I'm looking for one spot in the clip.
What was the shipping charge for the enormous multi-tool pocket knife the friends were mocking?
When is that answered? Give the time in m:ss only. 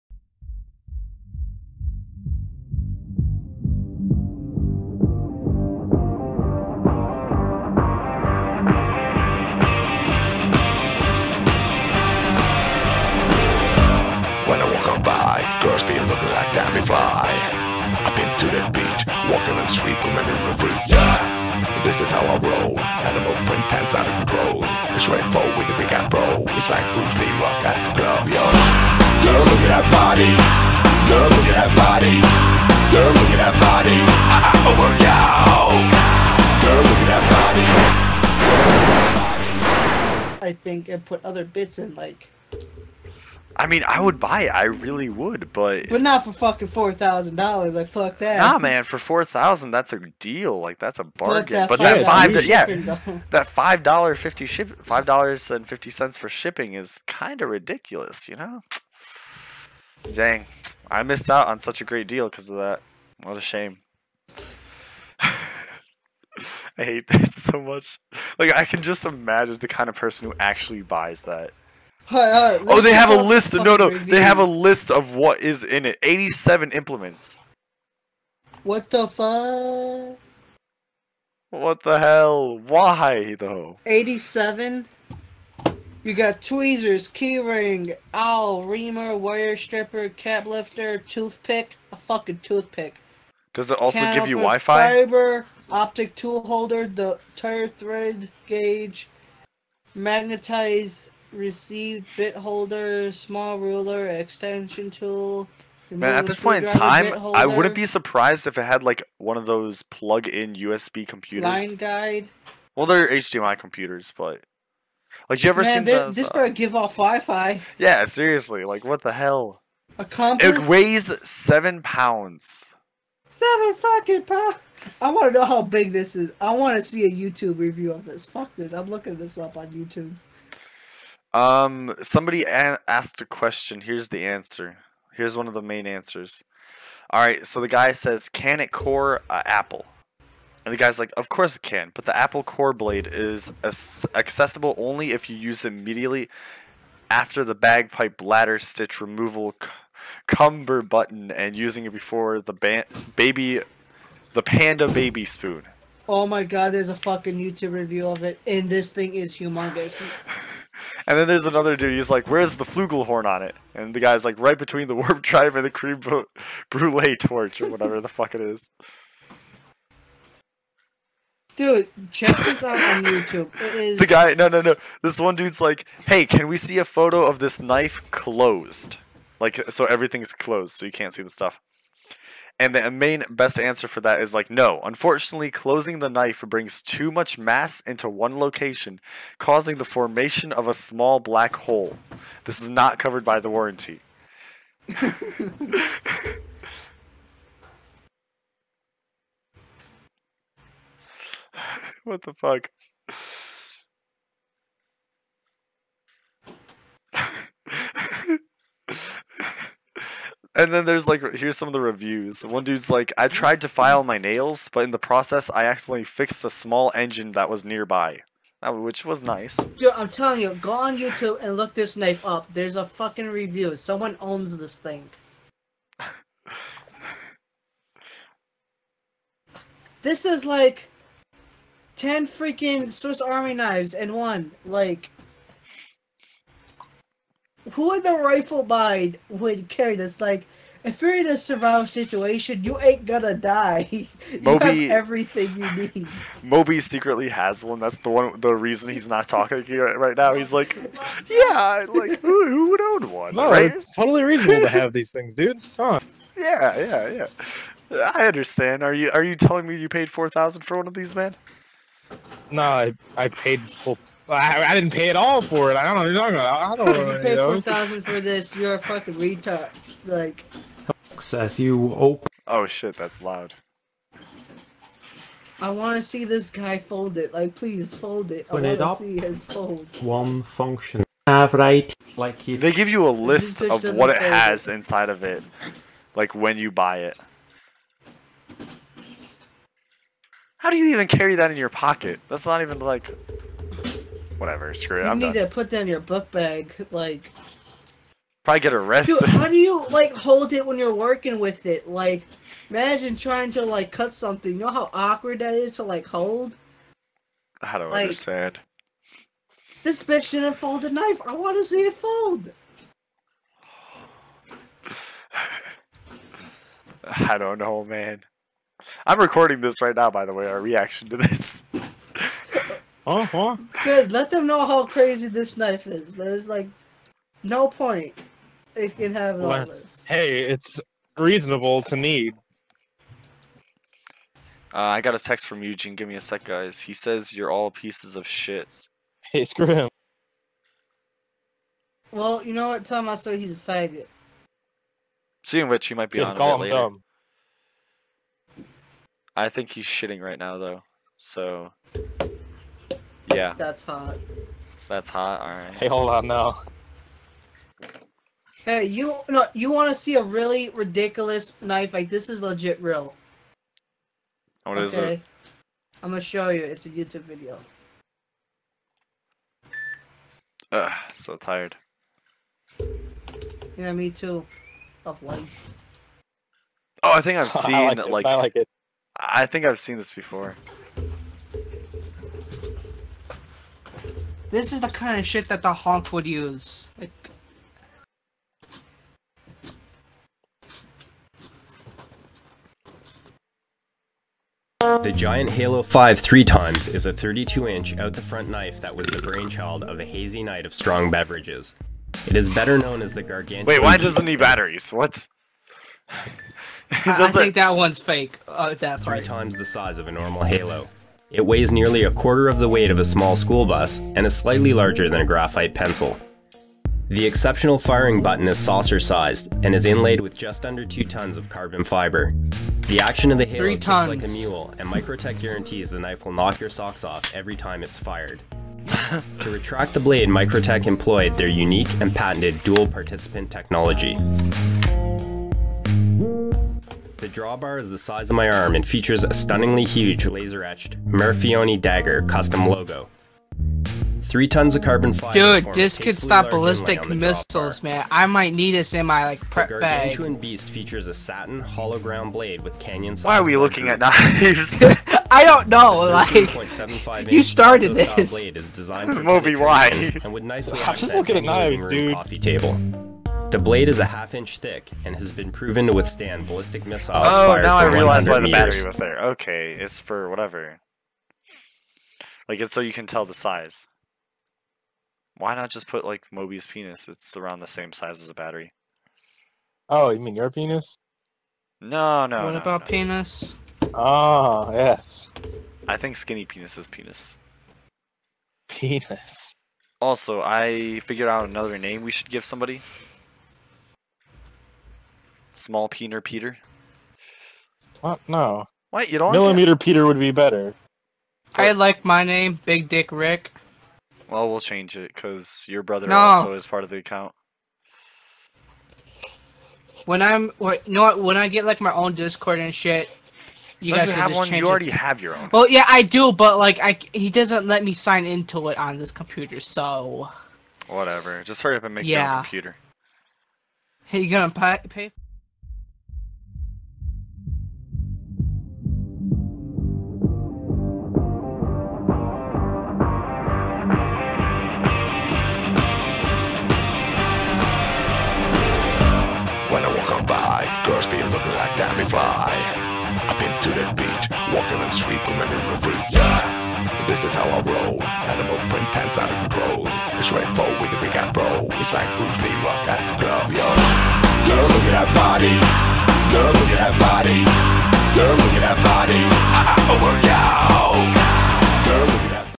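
0:54.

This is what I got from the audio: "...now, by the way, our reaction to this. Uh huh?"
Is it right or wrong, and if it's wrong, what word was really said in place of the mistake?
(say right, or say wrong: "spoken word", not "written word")
right.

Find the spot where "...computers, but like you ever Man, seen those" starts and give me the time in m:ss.
1:53.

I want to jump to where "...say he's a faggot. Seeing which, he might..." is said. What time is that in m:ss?
5:43.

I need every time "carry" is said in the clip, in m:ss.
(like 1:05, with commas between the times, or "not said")
3:59, 4:51.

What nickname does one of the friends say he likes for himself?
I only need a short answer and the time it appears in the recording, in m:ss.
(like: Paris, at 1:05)
Big Dick Rick, at 8:22.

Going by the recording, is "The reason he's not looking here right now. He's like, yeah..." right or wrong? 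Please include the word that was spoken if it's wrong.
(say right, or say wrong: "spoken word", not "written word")
wrong: "talking", not "looking".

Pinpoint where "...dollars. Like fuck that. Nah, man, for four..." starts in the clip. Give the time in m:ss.
0:47.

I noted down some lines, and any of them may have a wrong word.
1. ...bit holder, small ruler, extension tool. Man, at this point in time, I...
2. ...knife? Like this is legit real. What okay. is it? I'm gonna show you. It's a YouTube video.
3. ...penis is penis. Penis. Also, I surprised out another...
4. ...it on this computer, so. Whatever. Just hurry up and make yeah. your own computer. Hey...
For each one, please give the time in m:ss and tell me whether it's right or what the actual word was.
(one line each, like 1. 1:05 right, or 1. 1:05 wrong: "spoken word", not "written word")
1. 1:42 right
2. 6:01 right
3. 8:06 wrong: "figured", not "surprised"
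4. 8:38 right.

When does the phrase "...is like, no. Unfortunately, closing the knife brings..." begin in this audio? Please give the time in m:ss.
3:04.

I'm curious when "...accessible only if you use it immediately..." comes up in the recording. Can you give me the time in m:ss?
2:24.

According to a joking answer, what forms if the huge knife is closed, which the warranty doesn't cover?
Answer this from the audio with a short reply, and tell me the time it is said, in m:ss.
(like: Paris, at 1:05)
small black hole, at 3:10.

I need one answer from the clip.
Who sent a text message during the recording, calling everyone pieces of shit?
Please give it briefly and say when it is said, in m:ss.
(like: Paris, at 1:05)
Eugene, at 5:35.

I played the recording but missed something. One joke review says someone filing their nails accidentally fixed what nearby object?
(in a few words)
a small engine.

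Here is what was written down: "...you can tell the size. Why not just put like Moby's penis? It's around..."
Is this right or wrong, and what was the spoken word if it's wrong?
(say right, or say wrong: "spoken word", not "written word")
right.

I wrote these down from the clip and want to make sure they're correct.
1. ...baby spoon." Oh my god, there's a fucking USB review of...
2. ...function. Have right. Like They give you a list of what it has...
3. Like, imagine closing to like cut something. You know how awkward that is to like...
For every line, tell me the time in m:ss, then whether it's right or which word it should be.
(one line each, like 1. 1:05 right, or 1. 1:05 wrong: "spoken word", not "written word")
1. 2:34 wrong: "YouTube", not "USB"
2. 4:40 right
3. 5:01 wrong: "trying", not "closing".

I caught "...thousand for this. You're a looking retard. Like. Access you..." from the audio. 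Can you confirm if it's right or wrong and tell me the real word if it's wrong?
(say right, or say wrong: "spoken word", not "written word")
wrong: "fucking", not "looking".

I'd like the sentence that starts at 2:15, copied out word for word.
Here's one of the main answers.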